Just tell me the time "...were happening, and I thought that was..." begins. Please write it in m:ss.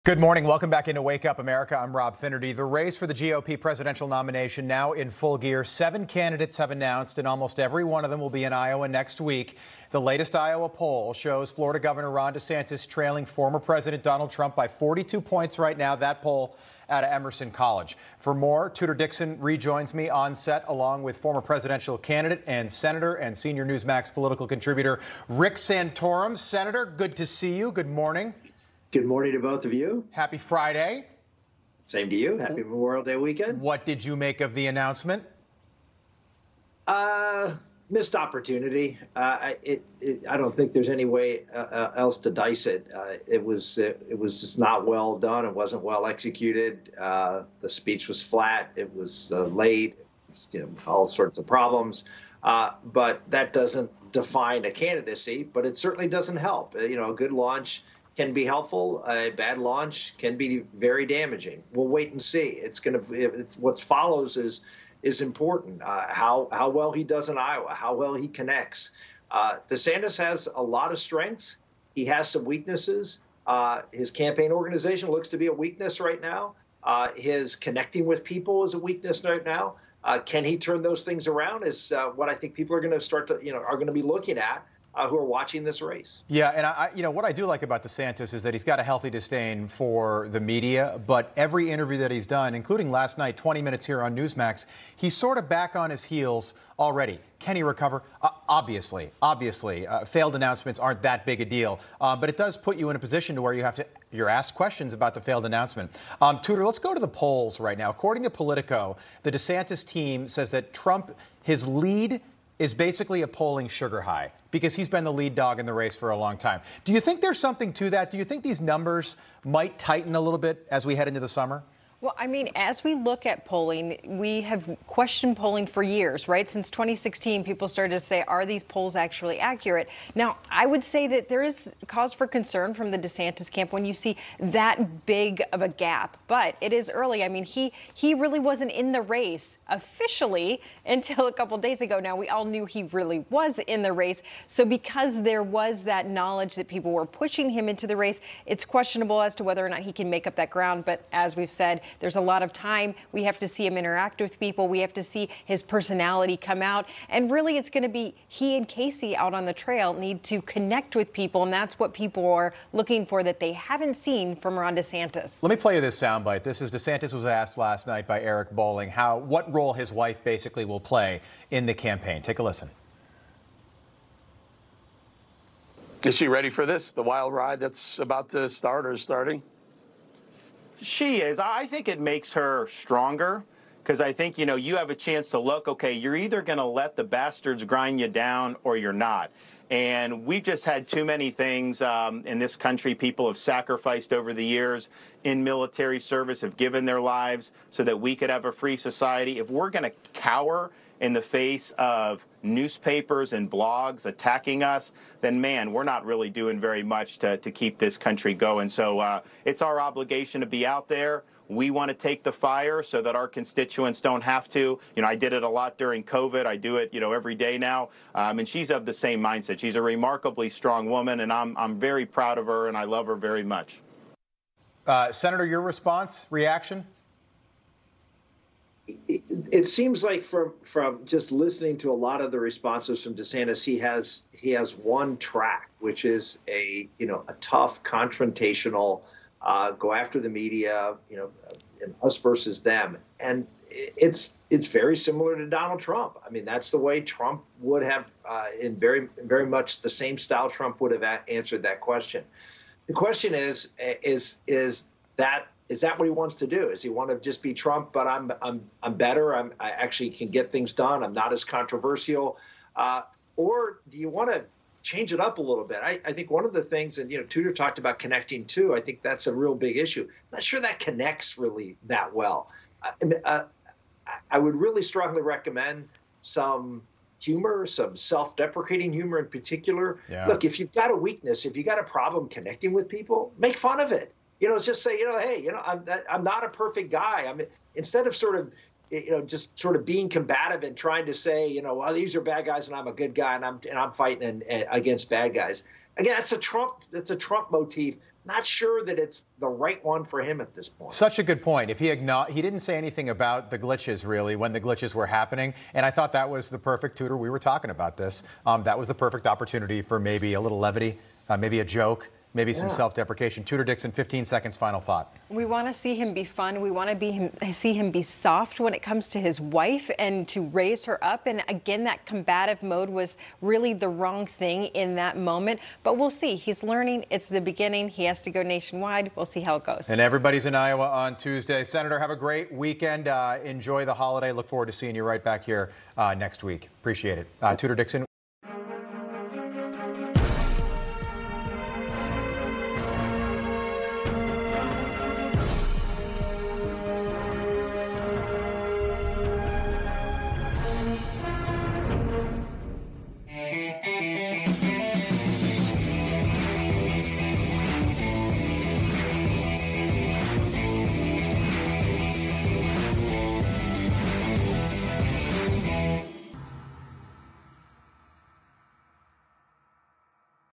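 5:04.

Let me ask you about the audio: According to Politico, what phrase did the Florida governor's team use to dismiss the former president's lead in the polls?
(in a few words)
polling sugar high.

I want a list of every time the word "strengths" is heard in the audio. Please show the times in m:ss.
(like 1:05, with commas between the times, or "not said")
1:10.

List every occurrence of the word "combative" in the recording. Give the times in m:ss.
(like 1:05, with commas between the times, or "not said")
4:50, 5:22.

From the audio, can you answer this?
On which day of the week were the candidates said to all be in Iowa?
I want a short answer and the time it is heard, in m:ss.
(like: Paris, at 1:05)
Tuesday, at 5:31.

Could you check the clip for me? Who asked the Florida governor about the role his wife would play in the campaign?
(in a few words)
Eric Bolling.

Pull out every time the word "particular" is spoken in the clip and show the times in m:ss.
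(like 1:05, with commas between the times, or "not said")
4:39.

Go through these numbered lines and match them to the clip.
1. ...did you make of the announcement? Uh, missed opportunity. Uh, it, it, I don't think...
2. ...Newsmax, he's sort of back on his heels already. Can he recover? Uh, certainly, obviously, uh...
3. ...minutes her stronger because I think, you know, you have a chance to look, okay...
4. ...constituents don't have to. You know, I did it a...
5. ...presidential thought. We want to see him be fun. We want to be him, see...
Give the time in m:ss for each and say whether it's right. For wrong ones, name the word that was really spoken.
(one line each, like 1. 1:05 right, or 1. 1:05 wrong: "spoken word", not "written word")
1. 0:33 right
2. 1:34 wrong: "obviously", not "certainly"
3. 3:01 wrong: "makes", not "minutes"
4. 3:33 right
5. 5:14 wrong: "final", not "presidential".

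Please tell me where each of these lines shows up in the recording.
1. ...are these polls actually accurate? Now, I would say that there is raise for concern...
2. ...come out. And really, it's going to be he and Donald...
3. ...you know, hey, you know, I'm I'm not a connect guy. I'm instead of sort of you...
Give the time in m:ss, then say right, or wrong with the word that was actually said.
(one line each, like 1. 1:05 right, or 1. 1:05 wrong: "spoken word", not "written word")
1. 2:08 wrong: "cause", not "raise"
2. 2:36 wrong: "Casey", not "Donald"
3. 4:44 wrong: "perfect", not "connect".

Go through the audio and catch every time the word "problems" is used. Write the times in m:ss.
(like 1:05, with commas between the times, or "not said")
0:51, 4:41.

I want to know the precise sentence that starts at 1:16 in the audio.
Uh, his connecting with people is a weakness right now.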